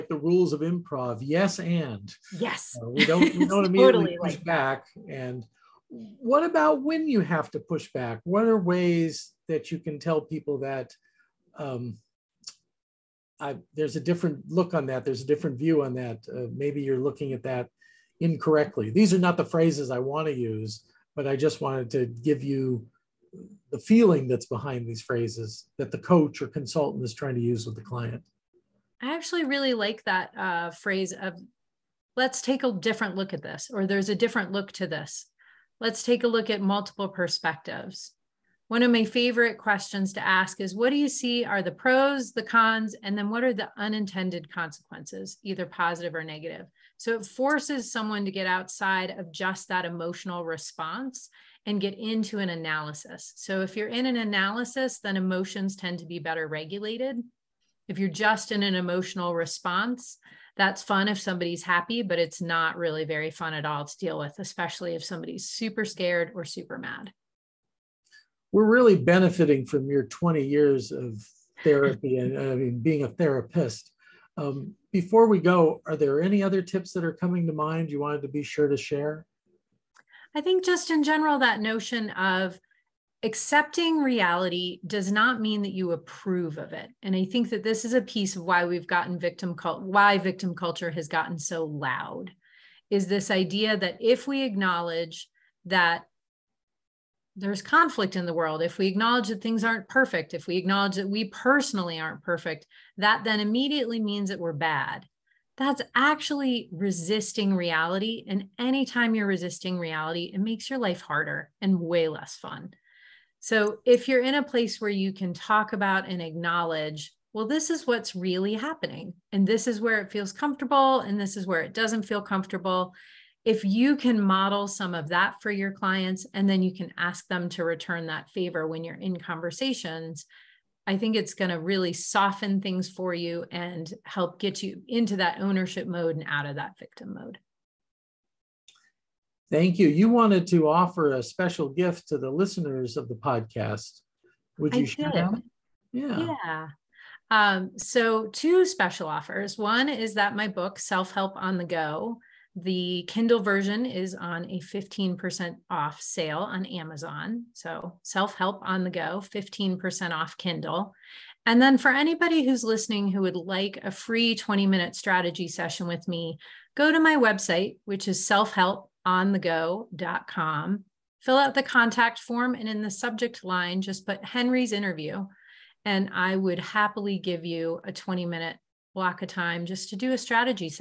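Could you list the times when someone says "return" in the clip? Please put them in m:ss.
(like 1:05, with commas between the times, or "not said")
2:07.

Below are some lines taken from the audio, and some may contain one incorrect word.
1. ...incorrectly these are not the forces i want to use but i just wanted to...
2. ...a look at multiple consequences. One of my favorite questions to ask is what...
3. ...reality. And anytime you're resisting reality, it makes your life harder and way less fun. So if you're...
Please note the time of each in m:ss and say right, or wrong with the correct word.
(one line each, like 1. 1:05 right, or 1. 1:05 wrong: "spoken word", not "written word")
1. 0:18 wrong: "phrases", not "forces"
2. 0:36 wrong: "perspectives", not "consequences"
3. 1:47 right.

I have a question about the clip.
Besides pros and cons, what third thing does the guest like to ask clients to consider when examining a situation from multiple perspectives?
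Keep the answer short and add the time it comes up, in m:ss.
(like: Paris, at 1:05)
unintended consequences, at 0:43.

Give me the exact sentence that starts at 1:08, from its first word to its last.
We're really benefiting from your 20 years of therapy and I mean, being a therapist.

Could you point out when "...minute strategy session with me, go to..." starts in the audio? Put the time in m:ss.
2:44.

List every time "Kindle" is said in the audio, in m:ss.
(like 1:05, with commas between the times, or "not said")
2:33, 2:40.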